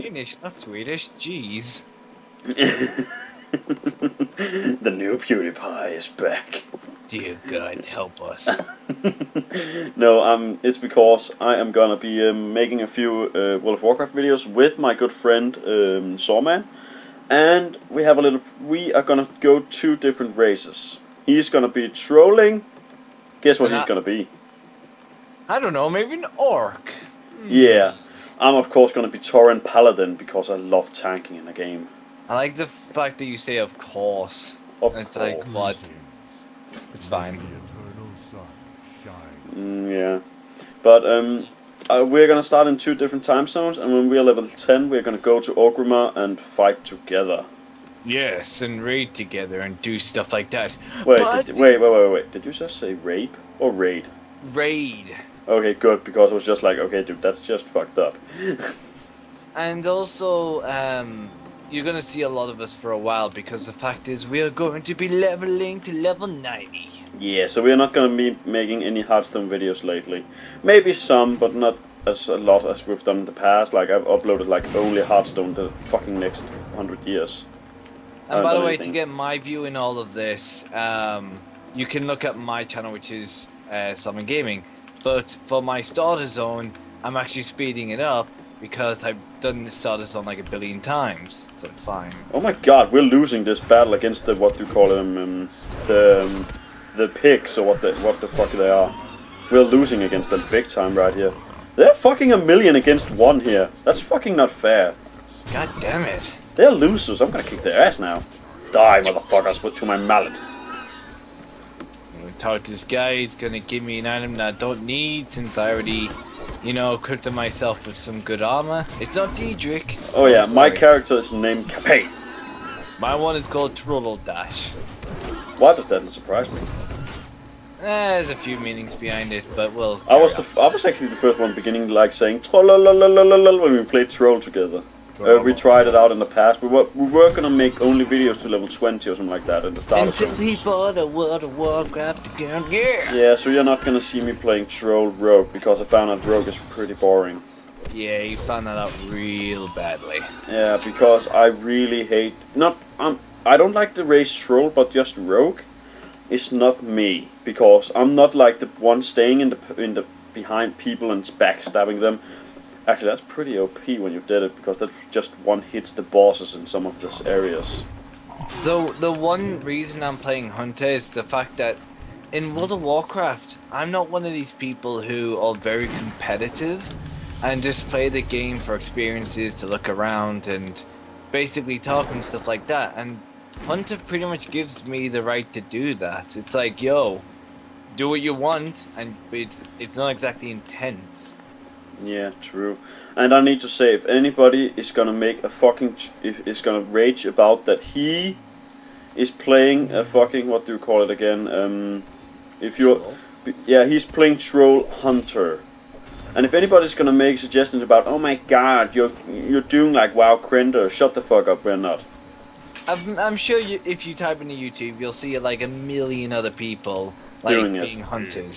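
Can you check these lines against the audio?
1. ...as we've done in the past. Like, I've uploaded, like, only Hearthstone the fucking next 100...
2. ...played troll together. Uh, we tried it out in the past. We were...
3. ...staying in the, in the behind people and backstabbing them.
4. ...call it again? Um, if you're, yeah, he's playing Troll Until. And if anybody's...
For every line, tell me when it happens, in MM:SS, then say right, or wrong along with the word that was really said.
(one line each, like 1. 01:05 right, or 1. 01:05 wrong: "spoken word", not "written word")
1. 01:12 right
2. 02:13 right
3. 02:39 right
4. 03:20 wrong: "Hunter", not "Until".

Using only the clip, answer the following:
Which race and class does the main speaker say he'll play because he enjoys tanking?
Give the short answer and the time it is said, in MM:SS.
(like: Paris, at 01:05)
Tauren Paladin, at 00:29.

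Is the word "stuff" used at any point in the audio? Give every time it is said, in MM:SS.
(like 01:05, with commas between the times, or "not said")
00:49, 03:02.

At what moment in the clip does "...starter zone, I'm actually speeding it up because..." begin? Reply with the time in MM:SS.
01:25.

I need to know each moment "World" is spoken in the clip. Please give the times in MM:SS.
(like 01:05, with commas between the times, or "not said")
00:13, 02:21, 02:52.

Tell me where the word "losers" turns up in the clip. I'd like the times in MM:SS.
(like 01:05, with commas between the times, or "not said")
01:46.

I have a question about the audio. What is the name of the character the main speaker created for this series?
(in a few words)
Capet.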